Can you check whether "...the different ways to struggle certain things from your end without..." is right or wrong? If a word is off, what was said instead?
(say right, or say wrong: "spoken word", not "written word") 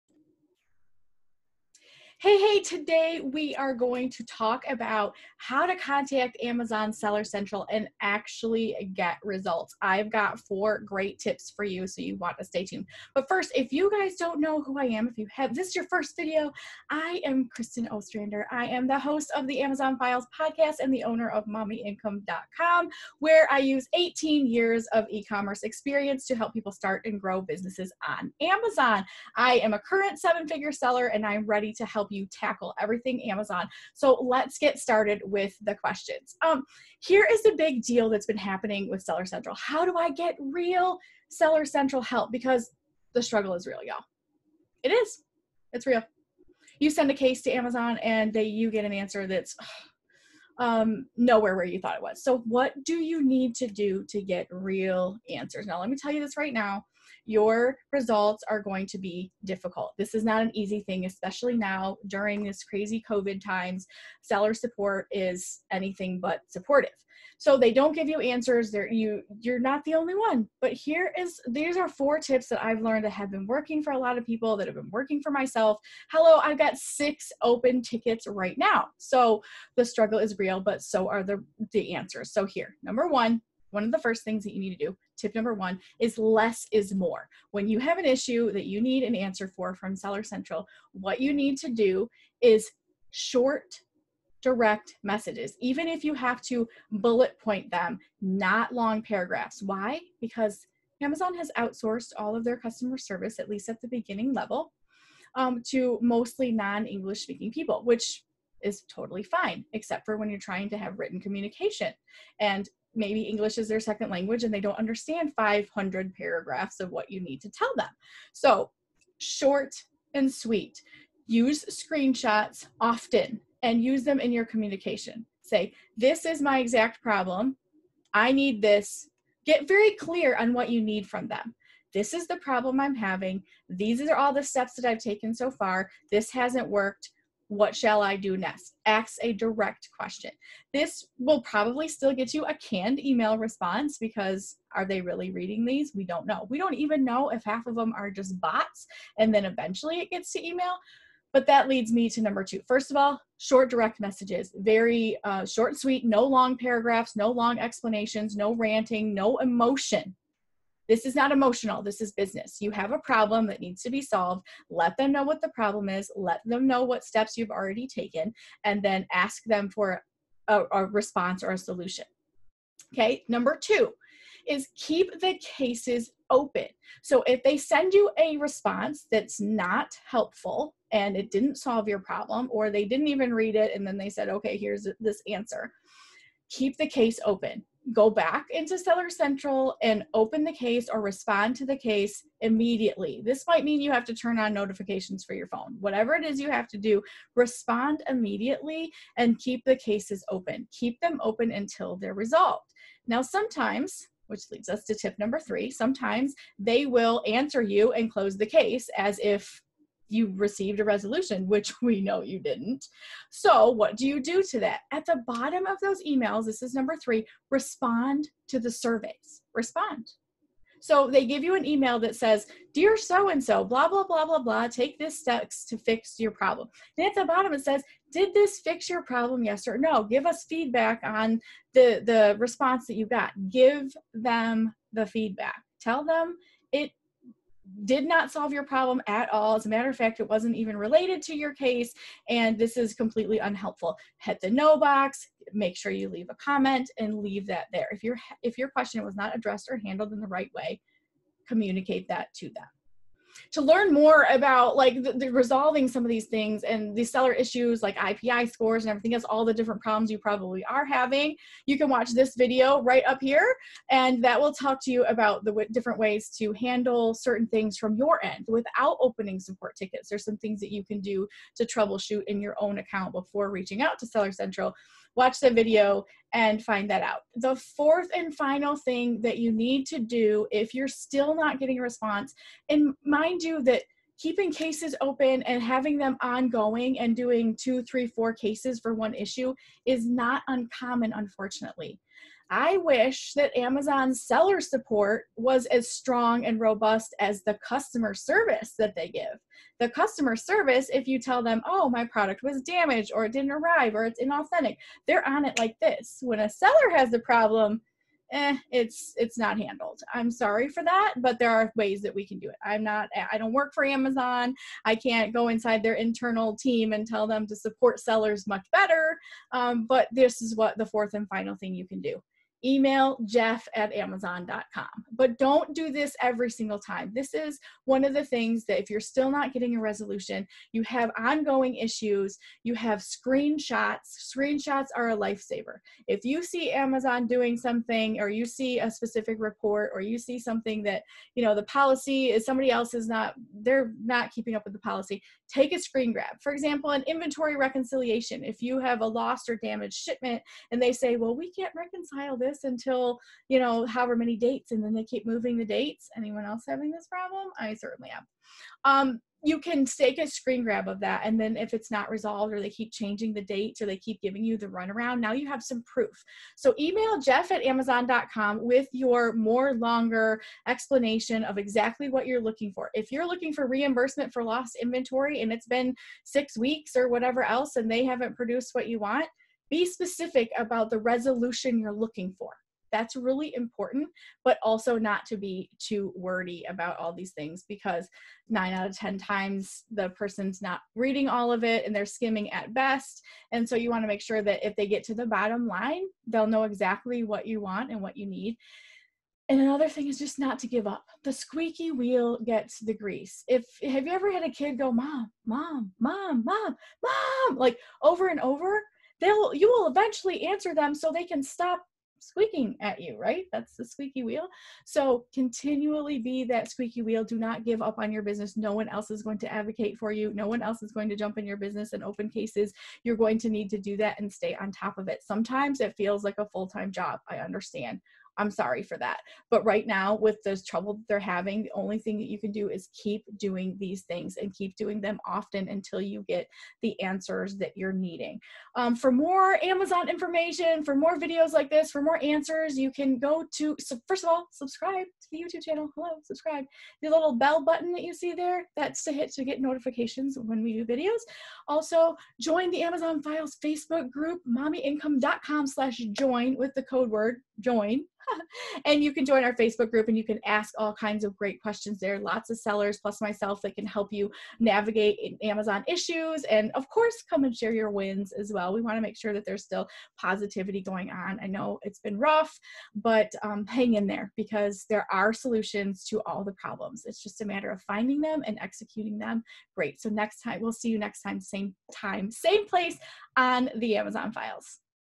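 wrong: "handle", not "struggle".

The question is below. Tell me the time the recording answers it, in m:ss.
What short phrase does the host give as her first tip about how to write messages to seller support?
1:26.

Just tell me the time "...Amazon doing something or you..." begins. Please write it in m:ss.
5:36.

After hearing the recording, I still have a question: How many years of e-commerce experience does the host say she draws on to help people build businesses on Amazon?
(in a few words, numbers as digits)
18.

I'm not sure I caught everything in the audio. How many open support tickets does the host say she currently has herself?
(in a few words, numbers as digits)
6.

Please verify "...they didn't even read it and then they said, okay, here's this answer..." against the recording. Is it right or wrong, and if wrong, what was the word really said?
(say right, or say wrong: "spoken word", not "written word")
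right.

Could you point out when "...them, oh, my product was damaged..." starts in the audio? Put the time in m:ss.
5:01.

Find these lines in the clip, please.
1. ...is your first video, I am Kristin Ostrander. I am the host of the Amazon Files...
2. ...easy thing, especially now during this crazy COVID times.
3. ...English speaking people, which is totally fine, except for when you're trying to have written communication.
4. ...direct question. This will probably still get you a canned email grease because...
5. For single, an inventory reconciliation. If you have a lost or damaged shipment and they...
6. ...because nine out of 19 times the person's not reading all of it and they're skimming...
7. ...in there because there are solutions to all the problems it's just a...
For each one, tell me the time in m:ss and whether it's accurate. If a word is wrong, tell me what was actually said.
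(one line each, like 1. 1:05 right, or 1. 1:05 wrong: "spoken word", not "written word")
1. 0:15 right
2. 1:00 right
3. 1:46 right
4. 2:19 wrong: "response", not "grease"
5. 5:46 wrong: "example", not "single"
6. 6:27 wrong: "10", not "19"
7. 7:53 right.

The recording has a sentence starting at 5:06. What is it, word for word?
When a seller has a problem, eh, it's it's not handled.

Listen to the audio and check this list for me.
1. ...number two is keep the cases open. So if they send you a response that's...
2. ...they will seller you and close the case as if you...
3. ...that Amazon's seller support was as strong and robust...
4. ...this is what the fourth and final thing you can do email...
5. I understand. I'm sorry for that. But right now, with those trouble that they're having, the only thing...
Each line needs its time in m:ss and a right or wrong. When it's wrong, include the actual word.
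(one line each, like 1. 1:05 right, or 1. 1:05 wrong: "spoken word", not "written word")
1. 2:53 right
2. 3:26 wrong: "answer", not "seller"
3. 4:53 right
4. 5:20 right
5. 7:07 right.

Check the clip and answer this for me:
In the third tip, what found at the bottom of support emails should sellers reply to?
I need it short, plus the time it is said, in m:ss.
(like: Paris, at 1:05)
The surveys, at 3:38.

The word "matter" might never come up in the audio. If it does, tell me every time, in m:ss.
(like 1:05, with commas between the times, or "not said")
3:59, 7:57.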